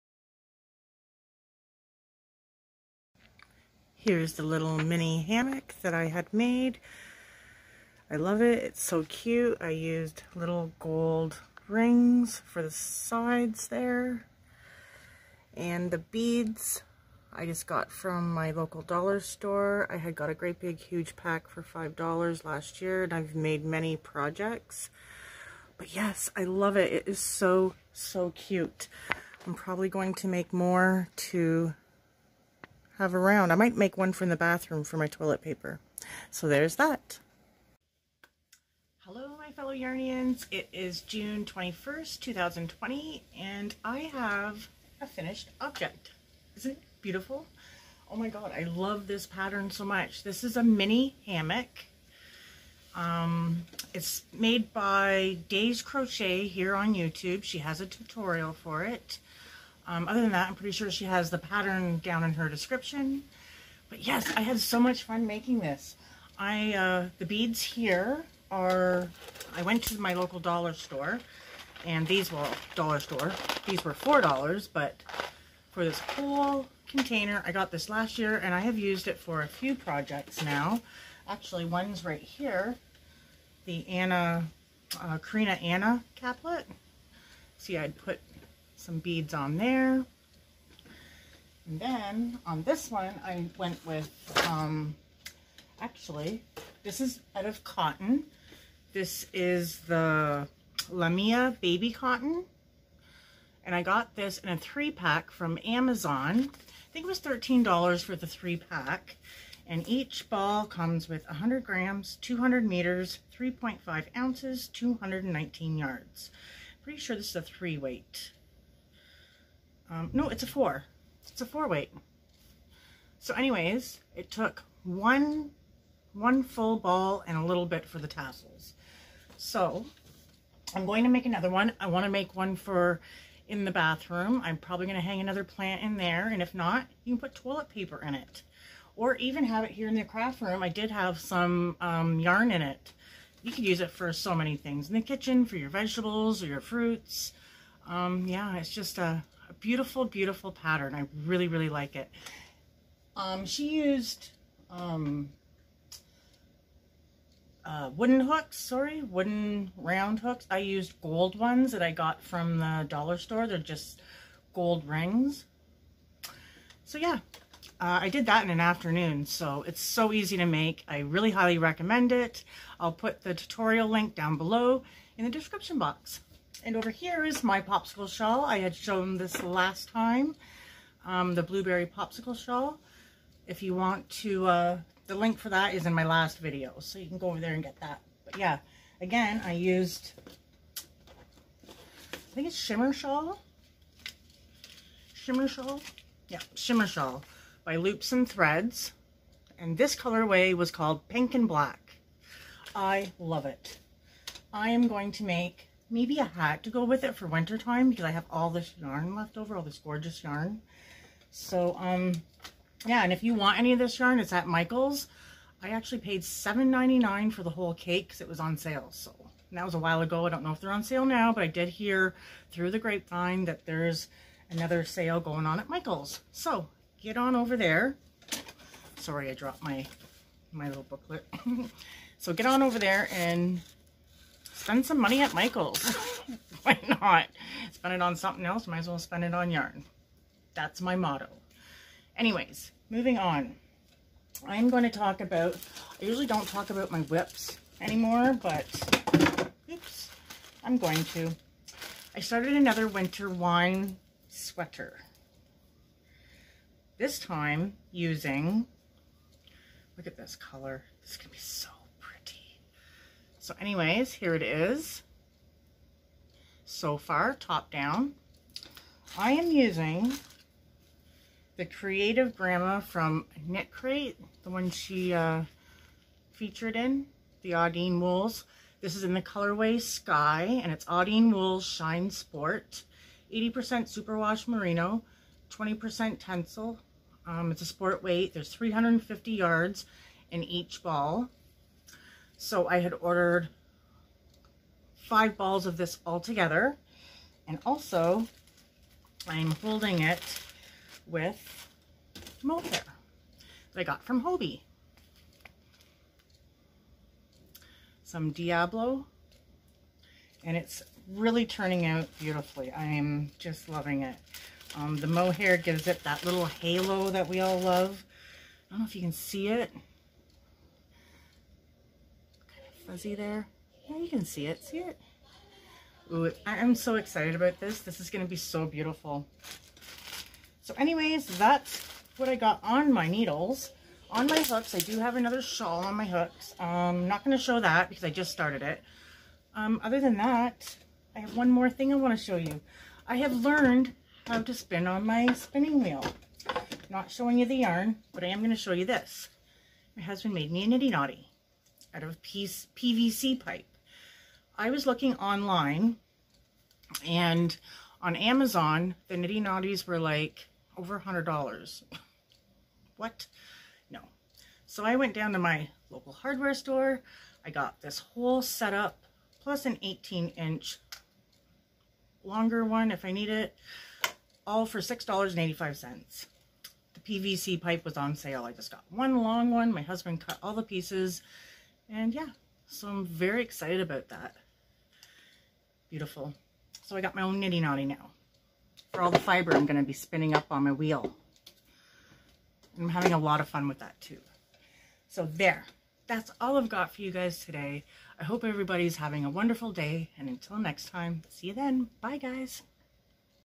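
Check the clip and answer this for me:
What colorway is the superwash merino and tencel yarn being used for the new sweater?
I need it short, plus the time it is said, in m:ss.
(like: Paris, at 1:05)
Sky, at 4:39.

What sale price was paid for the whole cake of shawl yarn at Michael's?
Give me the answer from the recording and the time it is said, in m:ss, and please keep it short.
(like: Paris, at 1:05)
$7.99, at 3:36.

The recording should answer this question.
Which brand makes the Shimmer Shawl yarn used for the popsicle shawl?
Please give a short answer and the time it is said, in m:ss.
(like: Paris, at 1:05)
Loops and Threads, at 3:17.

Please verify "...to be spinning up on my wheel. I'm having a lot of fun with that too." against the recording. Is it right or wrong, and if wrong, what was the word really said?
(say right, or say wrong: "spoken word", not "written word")
right.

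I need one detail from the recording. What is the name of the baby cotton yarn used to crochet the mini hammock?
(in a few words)
Lamia Baby Cotton.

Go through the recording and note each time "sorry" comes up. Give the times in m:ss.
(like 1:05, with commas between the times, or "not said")
2:38, 3:48.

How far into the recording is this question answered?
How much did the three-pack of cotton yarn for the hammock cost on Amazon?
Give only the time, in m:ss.
1:47.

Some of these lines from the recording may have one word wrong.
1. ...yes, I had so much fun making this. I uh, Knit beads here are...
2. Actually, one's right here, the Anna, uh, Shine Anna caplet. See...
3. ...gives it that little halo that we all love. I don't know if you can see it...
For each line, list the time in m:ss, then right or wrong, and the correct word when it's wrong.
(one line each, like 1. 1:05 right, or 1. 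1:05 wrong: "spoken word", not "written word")
1. 1:03 wrong: "The", not "Knit"
2. 1:21 wrong: "Karina", not "Shine"
3. 5:15 right.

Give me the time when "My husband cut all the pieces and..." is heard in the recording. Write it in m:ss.
6:19.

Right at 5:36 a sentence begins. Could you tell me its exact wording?
I'm um, not going to show that because I just started it.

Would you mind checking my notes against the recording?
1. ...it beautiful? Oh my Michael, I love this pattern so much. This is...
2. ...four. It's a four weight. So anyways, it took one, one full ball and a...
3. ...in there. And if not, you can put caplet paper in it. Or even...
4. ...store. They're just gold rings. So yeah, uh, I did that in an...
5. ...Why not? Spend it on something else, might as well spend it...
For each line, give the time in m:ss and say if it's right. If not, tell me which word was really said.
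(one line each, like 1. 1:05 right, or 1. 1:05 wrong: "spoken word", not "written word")
1. 0:46 wrong: "God", not "Michael"
2. 2:00 right
3. 2:15 wrong: "toilet", not "caplet"
4. 2:43 right
5. 3:56 right.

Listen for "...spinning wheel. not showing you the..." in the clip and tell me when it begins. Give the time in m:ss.
5:45.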